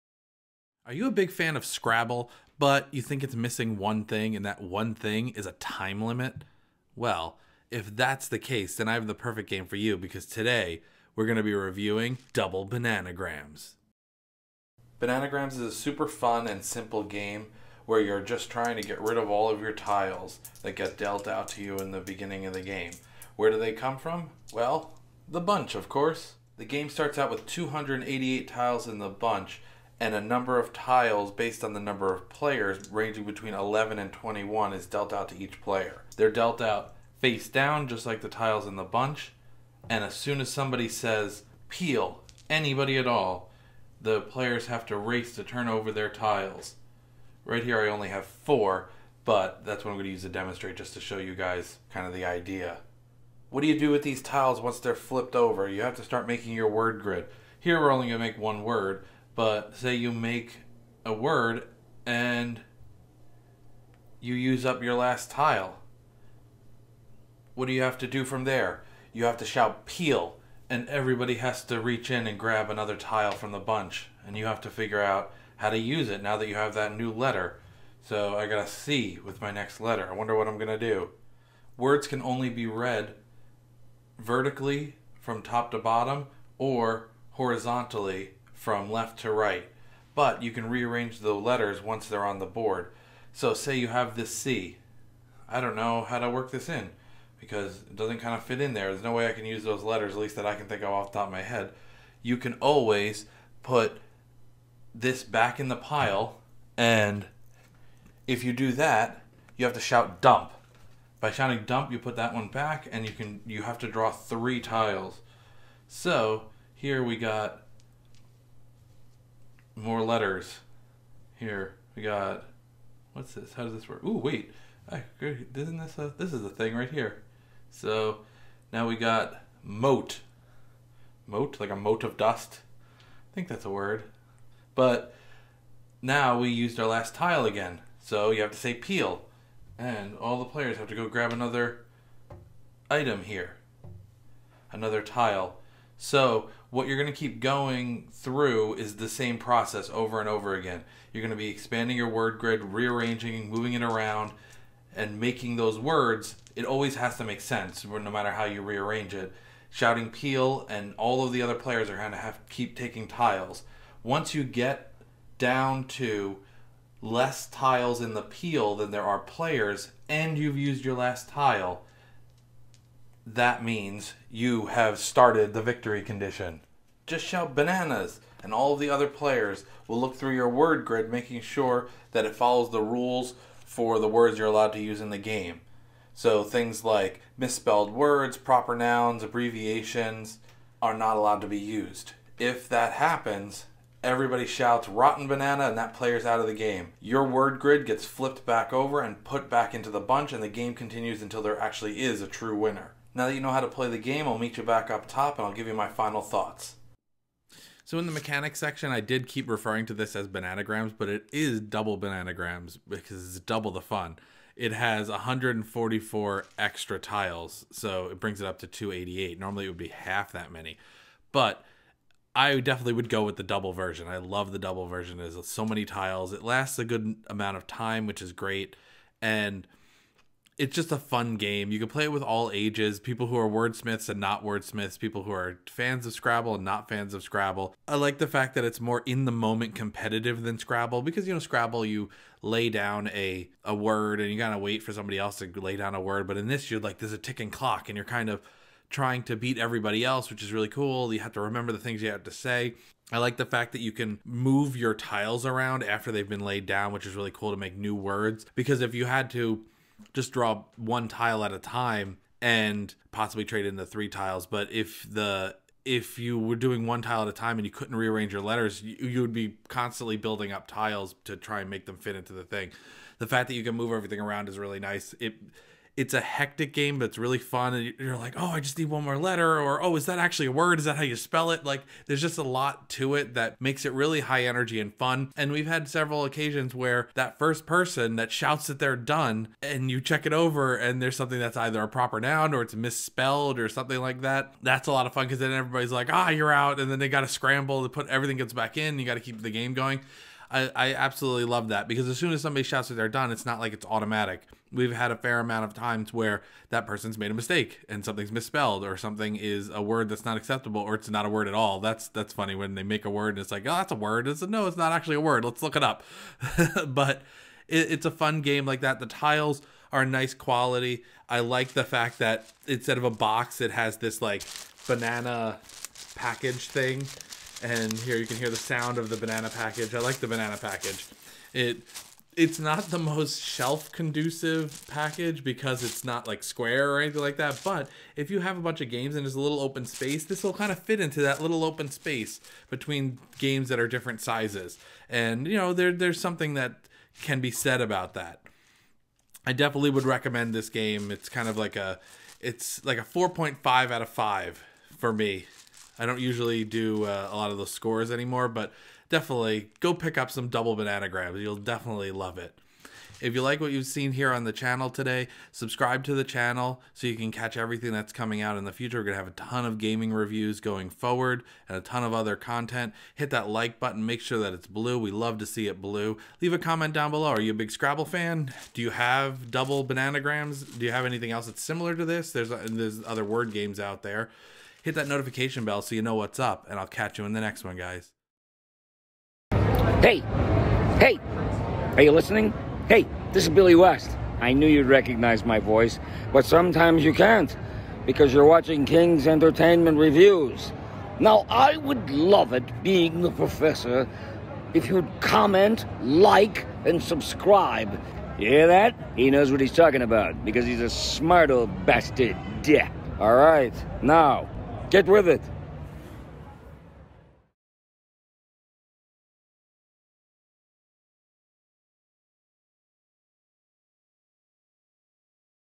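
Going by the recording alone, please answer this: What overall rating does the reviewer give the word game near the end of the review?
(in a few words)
4.5 out of 5.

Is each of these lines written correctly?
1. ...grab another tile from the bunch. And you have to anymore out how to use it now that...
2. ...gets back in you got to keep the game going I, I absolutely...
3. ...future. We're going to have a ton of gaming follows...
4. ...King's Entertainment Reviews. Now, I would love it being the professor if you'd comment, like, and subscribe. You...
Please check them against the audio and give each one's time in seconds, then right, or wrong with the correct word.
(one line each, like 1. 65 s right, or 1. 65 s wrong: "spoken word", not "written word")
1. 72 s wrong: "figure", not "anymore"
2. 298 s right
3. 368 s wrong: "reviews", not "follows"
4. 398 s right.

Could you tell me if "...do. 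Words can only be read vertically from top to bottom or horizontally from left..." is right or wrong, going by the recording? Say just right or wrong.
right.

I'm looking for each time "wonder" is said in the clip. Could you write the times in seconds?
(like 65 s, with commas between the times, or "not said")
80 s.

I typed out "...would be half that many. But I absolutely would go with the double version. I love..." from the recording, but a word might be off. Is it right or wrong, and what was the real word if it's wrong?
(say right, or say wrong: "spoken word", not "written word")
wrong: "definitely", not "absolutely".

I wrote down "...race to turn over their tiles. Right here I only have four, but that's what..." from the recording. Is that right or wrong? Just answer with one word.
right.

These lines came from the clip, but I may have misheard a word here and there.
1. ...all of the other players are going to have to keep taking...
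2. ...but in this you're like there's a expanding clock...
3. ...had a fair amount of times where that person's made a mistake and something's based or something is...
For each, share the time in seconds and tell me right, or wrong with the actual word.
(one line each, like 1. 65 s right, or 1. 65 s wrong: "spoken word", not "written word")
1. 160 s right
2. 246 s wrong: "ticking", not "expanding"
3. 304 s wrong: "misspelled", not "based".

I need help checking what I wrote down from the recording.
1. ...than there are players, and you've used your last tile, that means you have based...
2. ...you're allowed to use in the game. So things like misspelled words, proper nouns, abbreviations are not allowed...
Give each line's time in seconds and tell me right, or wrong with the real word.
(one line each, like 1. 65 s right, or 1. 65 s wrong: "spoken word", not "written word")
1. 168 s wrong: "started", not "based"
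2. 184 s right.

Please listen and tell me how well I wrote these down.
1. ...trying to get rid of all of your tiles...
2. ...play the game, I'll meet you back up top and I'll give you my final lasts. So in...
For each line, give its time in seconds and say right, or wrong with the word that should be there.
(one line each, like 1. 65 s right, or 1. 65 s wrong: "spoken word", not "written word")
1. 18 s right
2. 203 s wrong: "thoughts", not "lasts".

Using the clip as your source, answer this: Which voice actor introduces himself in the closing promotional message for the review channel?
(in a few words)
Billy West.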